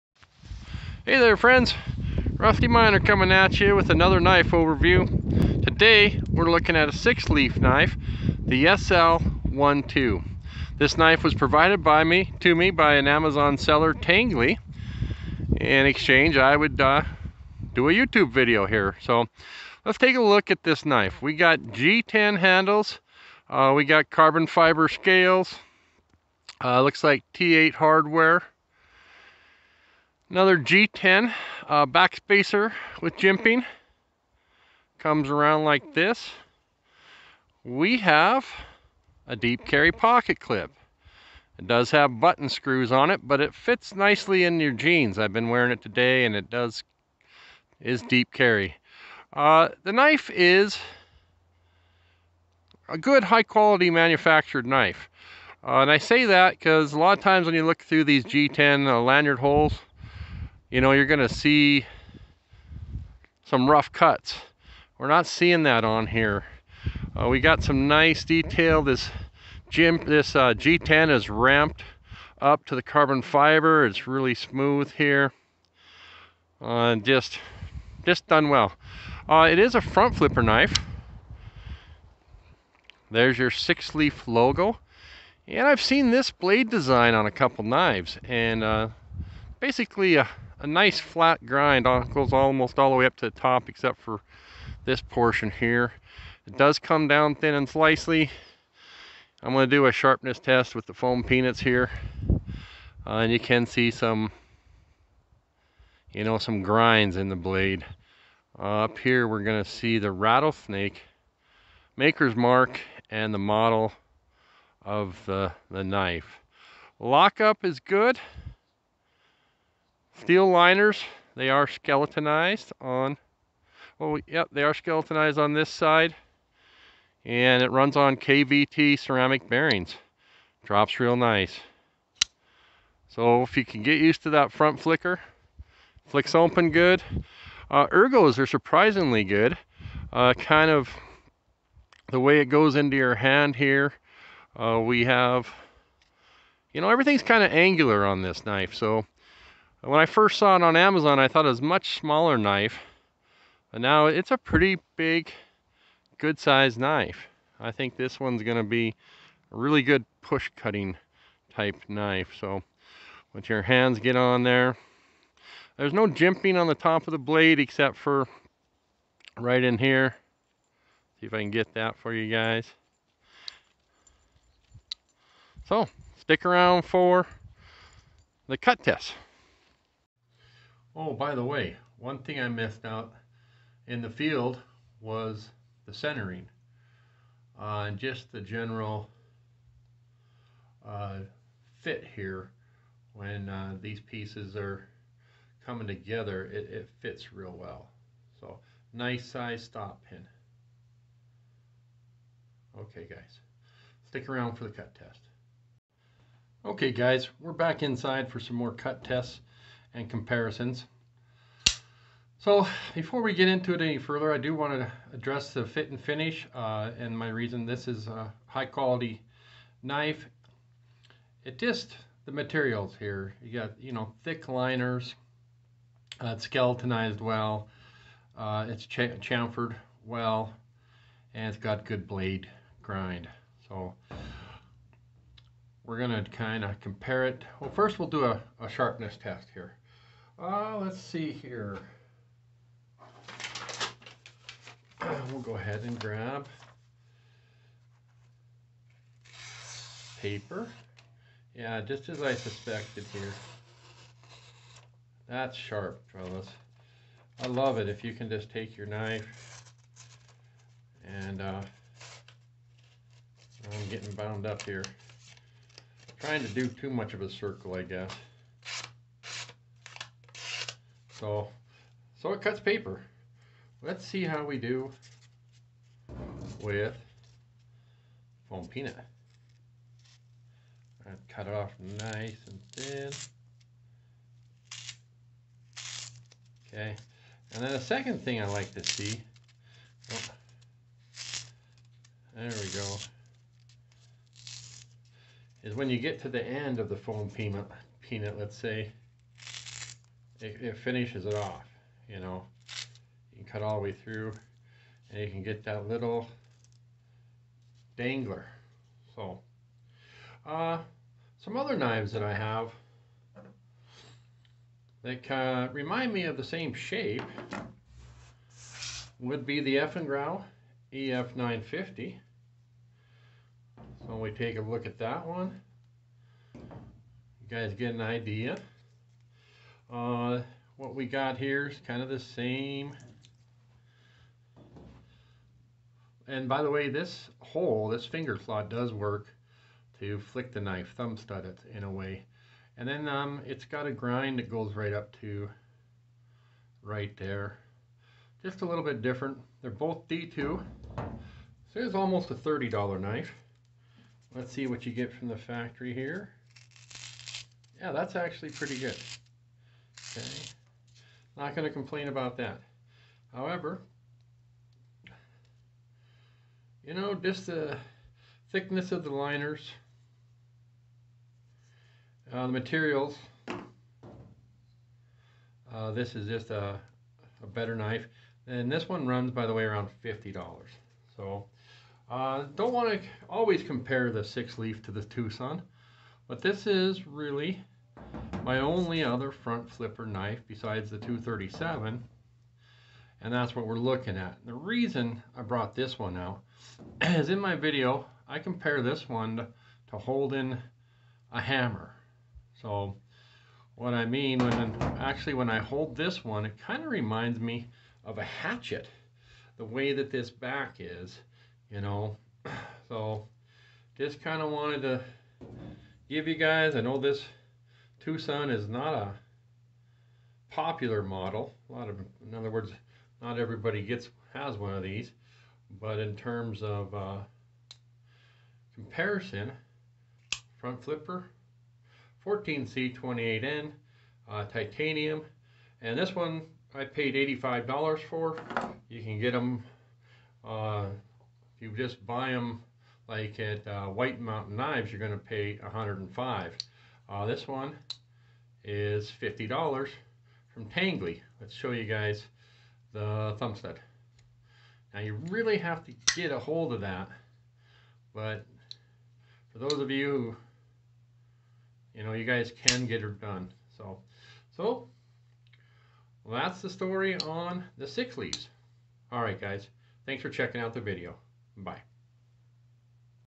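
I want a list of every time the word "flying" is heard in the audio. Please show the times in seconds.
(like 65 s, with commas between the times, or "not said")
not said.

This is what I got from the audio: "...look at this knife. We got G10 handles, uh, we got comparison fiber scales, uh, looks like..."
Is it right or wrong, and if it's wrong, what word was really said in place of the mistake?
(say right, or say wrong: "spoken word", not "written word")
wrong: "carbon", not "comparison".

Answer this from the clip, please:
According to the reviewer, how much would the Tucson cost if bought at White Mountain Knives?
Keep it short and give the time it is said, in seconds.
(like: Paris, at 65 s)
$105, at 445 s.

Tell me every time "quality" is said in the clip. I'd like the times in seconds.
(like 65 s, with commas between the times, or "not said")
53 s, 218 s.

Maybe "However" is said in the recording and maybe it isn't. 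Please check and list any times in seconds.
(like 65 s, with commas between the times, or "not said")
363 s.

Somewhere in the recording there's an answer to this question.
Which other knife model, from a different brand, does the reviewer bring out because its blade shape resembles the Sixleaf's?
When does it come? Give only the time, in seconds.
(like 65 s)
319 s.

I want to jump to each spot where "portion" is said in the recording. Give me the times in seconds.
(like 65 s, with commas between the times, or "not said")
95 s.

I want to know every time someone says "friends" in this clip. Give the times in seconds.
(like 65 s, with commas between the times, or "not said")
1 s.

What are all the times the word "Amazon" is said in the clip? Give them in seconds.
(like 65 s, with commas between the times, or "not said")
13 s, 150 s.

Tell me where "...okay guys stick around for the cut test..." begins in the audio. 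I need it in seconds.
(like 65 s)
202 s.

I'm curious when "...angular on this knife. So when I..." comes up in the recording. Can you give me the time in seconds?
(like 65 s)
147 s.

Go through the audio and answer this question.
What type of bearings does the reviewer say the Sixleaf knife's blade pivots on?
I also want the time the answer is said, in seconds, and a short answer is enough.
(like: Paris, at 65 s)
KVT ceramic bearings, at 128 s.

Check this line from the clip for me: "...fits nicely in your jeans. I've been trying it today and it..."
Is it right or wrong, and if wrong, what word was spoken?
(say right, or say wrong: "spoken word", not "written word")
wrong: "wearing", not "trying".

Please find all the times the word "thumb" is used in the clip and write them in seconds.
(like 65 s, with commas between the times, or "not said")
340 s, 453 s.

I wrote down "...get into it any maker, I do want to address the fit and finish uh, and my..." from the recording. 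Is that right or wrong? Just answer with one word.
wrong.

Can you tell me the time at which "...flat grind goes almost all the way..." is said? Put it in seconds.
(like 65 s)
90 s.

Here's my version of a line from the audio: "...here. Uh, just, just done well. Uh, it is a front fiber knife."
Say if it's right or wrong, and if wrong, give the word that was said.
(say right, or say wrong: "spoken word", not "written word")
wrong: "flipper", not "fiber".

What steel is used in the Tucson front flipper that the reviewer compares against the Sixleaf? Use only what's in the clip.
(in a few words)
14C28N.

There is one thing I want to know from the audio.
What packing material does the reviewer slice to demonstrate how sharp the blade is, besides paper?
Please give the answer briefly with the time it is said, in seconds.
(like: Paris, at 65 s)
foam peanuts, at 100 s.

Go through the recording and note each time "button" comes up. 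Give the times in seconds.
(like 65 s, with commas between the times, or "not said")
42 s.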